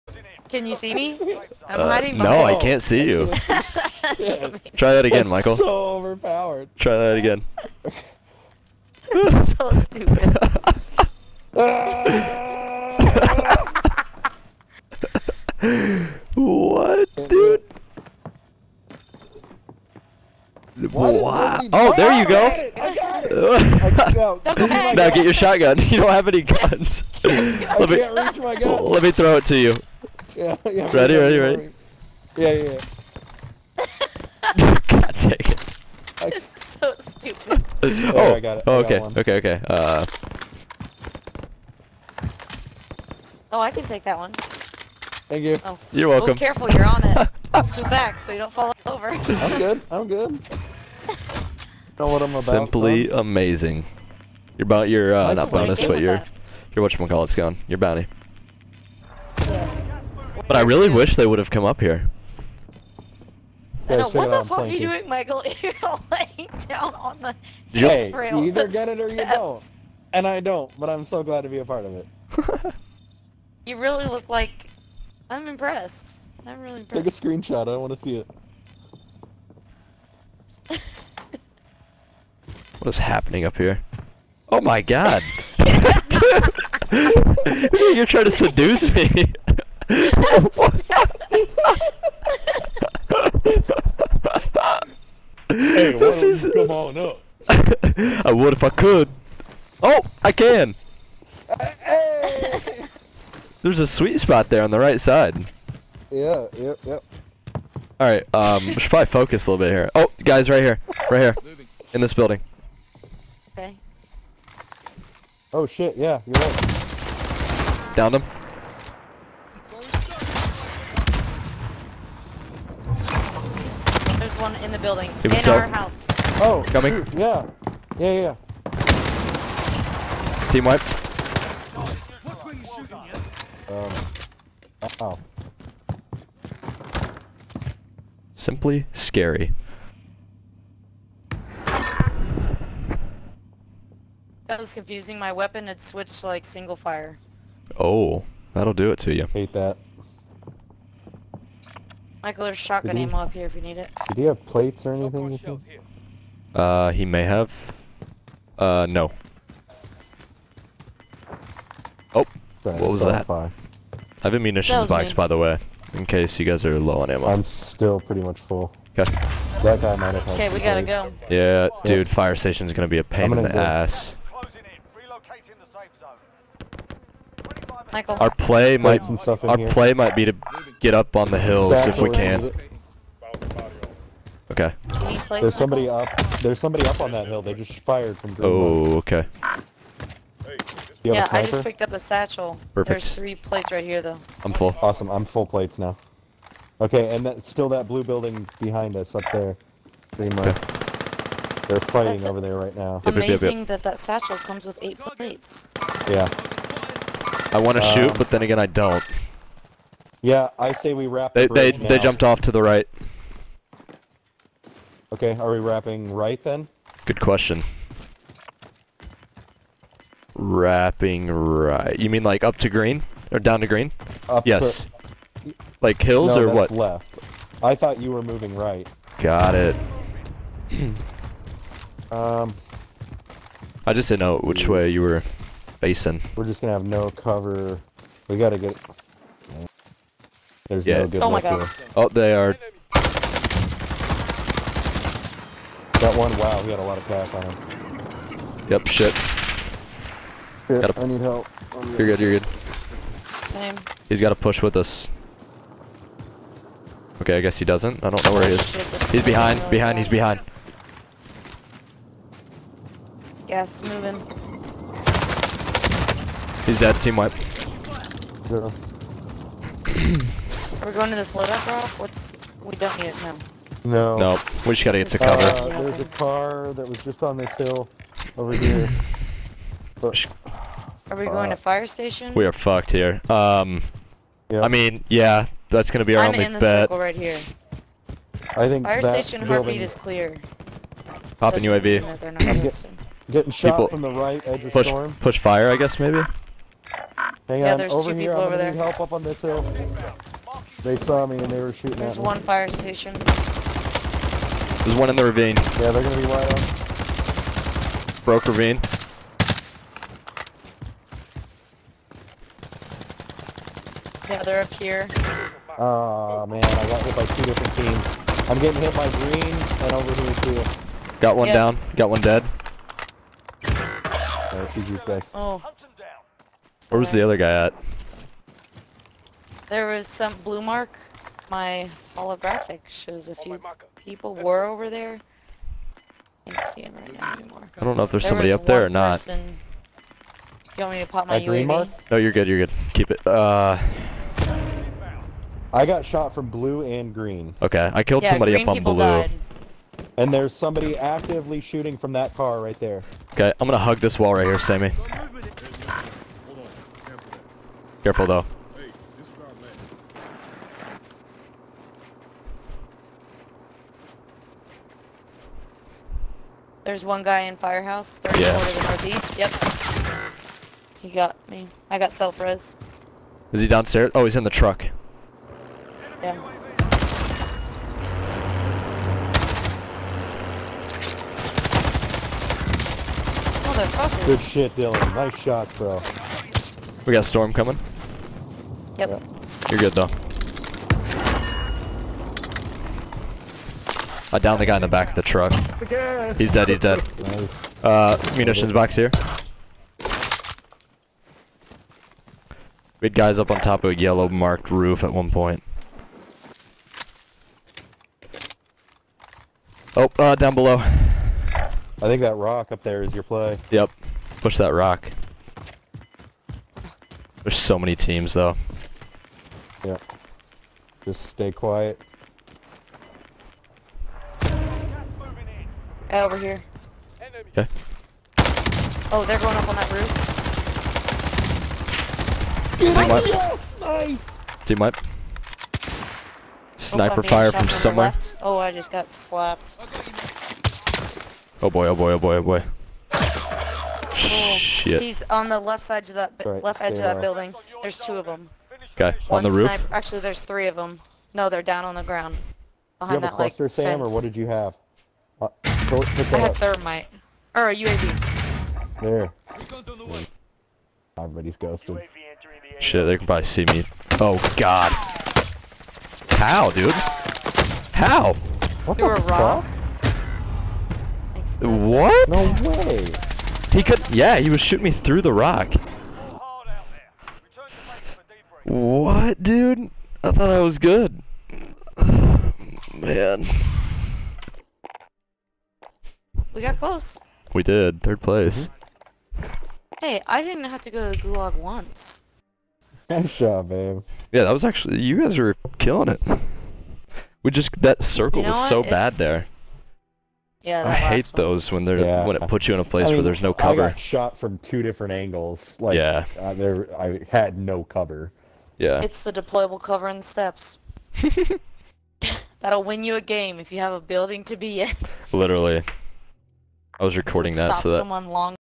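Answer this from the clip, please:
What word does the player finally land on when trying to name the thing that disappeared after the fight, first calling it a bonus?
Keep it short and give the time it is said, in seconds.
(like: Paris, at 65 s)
Bounty, at 57 s.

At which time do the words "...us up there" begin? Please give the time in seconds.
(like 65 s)
198 s.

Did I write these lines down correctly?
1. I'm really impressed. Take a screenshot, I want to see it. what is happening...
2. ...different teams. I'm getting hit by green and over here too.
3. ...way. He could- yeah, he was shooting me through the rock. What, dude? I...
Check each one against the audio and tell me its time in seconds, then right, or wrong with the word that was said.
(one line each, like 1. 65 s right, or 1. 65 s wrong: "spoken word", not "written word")
1. 76 s right
2. 317 s right
3. 472 s right.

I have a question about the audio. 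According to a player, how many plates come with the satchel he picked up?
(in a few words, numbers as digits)
8.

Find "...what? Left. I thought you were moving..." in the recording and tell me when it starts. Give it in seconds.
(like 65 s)
226 s.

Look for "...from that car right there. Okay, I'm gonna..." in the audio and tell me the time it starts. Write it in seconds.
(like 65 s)
351 s.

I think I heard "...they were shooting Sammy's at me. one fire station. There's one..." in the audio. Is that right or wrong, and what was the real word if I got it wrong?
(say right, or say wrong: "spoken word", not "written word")
wrong: "There", not "Sammy".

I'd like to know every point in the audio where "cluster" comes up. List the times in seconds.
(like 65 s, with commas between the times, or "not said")
453 s.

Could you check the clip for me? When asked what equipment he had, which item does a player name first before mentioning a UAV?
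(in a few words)
thermite.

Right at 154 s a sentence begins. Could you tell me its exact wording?
Did he have plates or anything?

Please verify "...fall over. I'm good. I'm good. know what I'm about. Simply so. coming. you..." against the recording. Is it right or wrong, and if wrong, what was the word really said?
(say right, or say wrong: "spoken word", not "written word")
wrong: "amazing", not "coming".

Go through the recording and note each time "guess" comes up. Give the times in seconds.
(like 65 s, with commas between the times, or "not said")
257 s, 295 s.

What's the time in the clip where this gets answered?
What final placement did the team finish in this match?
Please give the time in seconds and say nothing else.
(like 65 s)
488 s.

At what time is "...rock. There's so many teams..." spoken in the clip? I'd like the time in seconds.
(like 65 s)
414 s.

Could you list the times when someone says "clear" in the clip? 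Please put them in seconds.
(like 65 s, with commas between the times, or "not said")
289 s.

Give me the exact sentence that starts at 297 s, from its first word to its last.
Hang yeah, on, there's over two here.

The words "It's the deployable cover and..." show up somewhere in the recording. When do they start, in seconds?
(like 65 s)
509 s.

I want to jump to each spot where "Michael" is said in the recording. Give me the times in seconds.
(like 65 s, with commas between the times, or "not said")
5 s, 65 s, 152 s, 177 s.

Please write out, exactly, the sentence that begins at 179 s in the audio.
play might be to get up on the hills if we can.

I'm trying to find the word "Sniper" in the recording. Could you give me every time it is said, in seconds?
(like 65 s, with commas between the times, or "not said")
436 s, 449 s.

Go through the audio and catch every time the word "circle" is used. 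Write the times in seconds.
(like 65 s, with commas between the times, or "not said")
286 s, 498 s.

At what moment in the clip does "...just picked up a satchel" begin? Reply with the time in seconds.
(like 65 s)
191 s.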